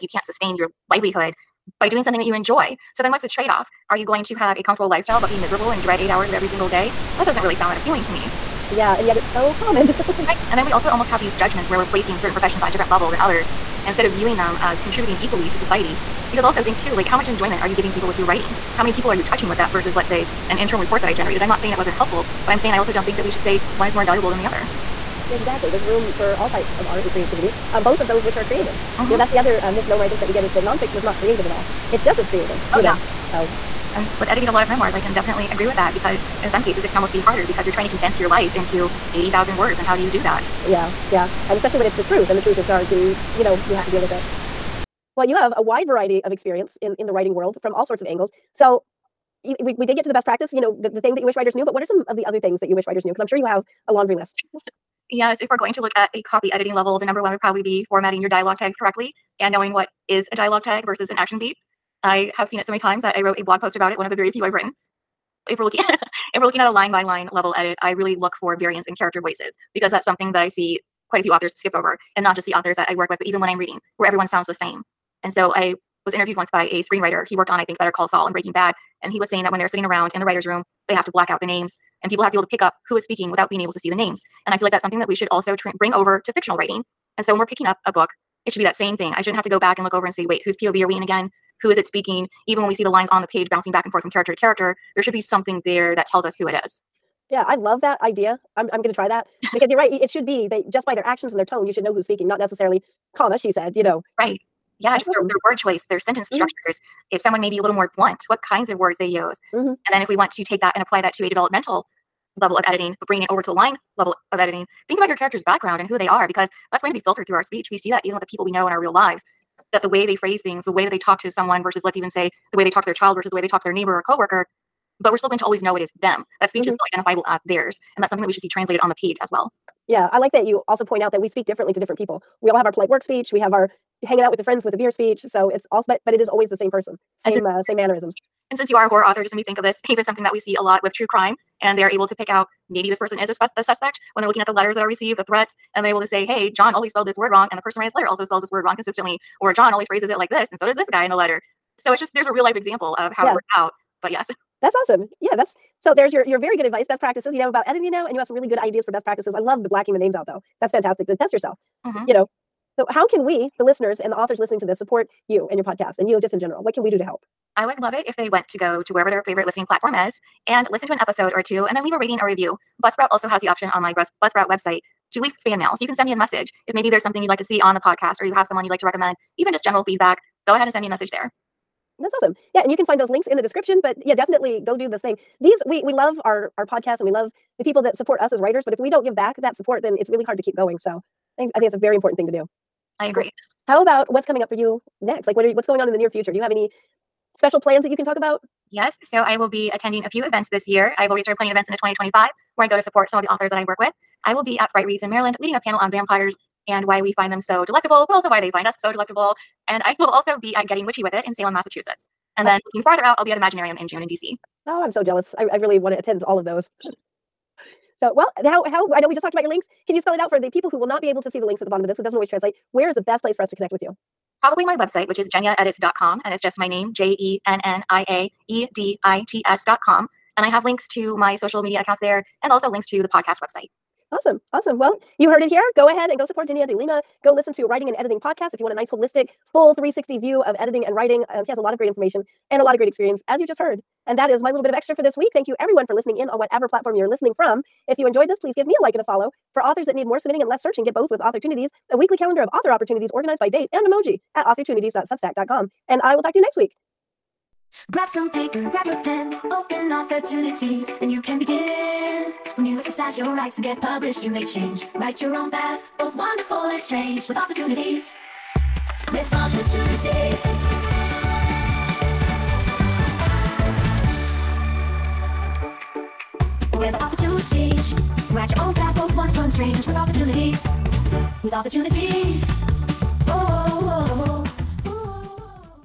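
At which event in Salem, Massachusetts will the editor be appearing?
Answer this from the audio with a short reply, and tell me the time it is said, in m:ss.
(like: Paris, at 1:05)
Getting Witchy with It, at 3:30.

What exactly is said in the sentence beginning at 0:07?
That doesn't really sound that appealing to me.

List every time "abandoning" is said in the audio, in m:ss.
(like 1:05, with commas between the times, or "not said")
not said.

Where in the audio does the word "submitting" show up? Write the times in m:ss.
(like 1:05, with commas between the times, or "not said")
4:10.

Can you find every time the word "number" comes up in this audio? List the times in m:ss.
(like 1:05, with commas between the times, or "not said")
0:57.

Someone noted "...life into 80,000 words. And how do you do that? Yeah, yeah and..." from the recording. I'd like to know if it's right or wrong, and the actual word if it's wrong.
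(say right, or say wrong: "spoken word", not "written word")
right.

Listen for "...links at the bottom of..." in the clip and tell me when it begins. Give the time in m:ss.
3:41.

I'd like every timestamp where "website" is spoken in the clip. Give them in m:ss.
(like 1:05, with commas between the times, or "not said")
2:54, 3:44, 3:53.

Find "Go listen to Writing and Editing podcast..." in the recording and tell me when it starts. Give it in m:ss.
3:57.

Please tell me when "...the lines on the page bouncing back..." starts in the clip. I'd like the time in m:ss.
1:32.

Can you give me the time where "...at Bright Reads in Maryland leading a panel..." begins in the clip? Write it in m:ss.
3:24.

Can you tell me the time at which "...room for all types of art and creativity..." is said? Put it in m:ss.
0:25.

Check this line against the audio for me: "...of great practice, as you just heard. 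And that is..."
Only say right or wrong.
wrong.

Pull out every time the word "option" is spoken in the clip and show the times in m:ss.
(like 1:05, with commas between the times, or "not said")
2:53.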